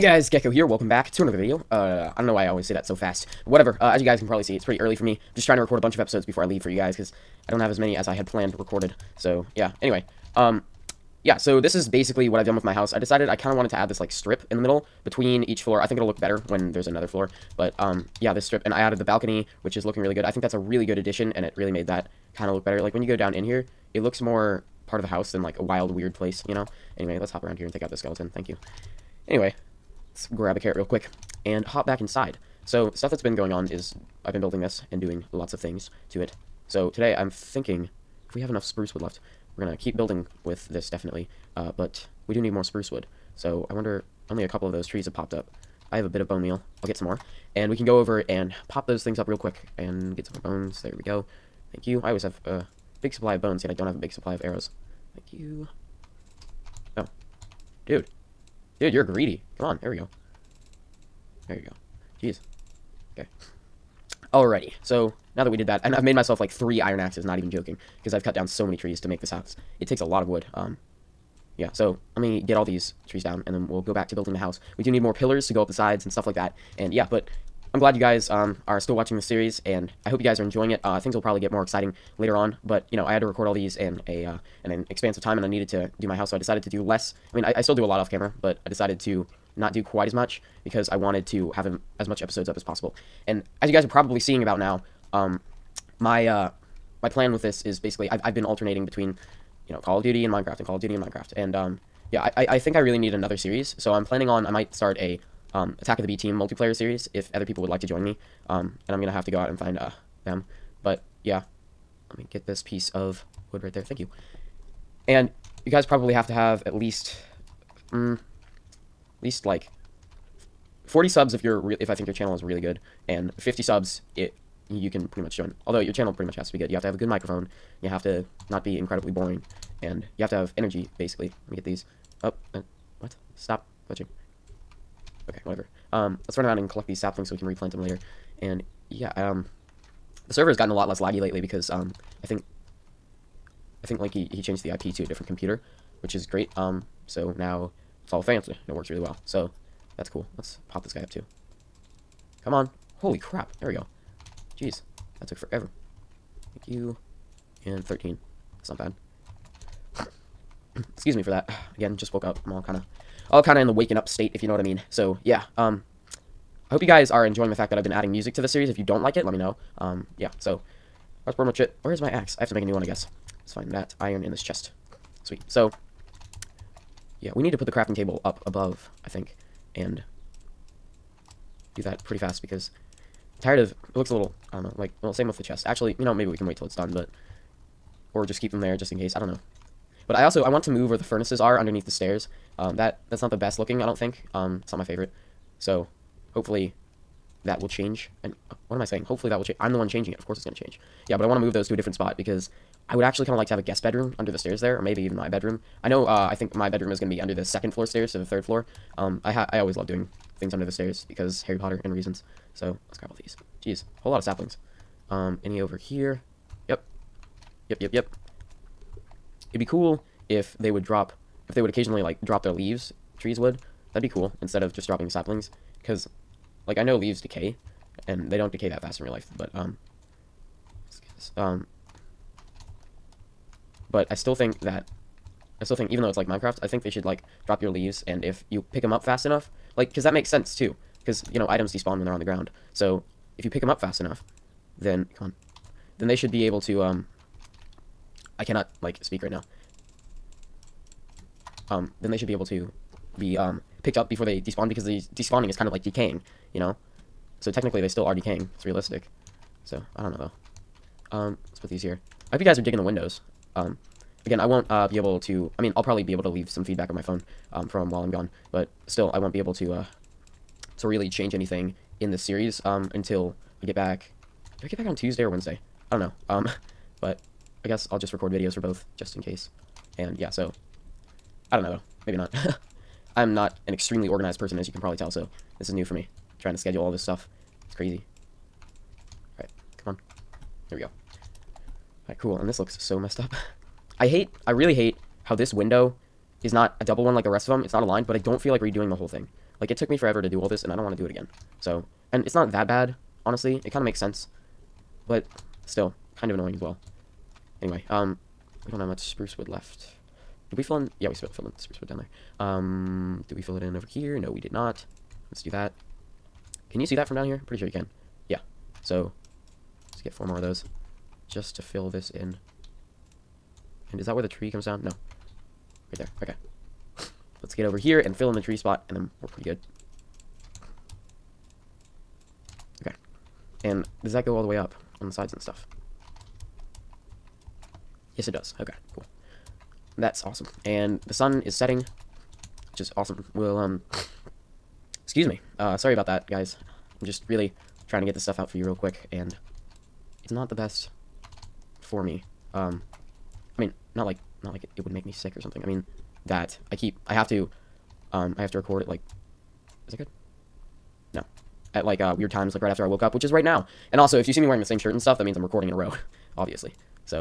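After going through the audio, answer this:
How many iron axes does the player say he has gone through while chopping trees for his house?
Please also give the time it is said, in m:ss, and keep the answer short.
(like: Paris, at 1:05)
3, at 1:06.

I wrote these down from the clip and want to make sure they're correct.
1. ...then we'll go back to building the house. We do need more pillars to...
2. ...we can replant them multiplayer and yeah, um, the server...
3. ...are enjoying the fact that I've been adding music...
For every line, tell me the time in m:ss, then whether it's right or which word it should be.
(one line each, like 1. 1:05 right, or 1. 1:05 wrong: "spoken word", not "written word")
1. 1:13 right
2. 2:17 wrong: "later", not "multiplayer"
3. 2:47 right.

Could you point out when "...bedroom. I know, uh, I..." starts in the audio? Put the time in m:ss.
3:25.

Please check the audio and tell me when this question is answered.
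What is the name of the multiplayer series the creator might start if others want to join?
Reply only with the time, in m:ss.
1:45.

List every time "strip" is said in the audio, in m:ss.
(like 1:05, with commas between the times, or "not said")
0:14, 0:18.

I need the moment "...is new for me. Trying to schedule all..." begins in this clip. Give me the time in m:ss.
4:45.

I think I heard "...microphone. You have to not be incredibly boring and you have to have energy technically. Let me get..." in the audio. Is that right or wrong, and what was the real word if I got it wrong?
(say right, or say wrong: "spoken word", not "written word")
wrong: "basically", not "technically".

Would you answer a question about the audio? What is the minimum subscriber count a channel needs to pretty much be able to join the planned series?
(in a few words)
50.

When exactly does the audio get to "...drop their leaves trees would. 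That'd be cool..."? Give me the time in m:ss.
3:42.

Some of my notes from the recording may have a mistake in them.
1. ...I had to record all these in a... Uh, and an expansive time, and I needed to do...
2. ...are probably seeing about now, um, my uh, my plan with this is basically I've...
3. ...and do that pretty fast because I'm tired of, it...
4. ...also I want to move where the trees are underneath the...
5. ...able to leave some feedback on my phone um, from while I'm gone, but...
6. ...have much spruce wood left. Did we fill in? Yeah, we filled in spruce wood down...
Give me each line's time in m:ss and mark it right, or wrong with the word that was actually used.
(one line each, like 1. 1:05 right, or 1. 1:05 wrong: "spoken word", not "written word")
1. 1:23 right
2. 1:33 right
3. 2:59 right
4. 3:10 wrong: "furnaces", not "trees"
5. 4:26 right
6. 5:08 right.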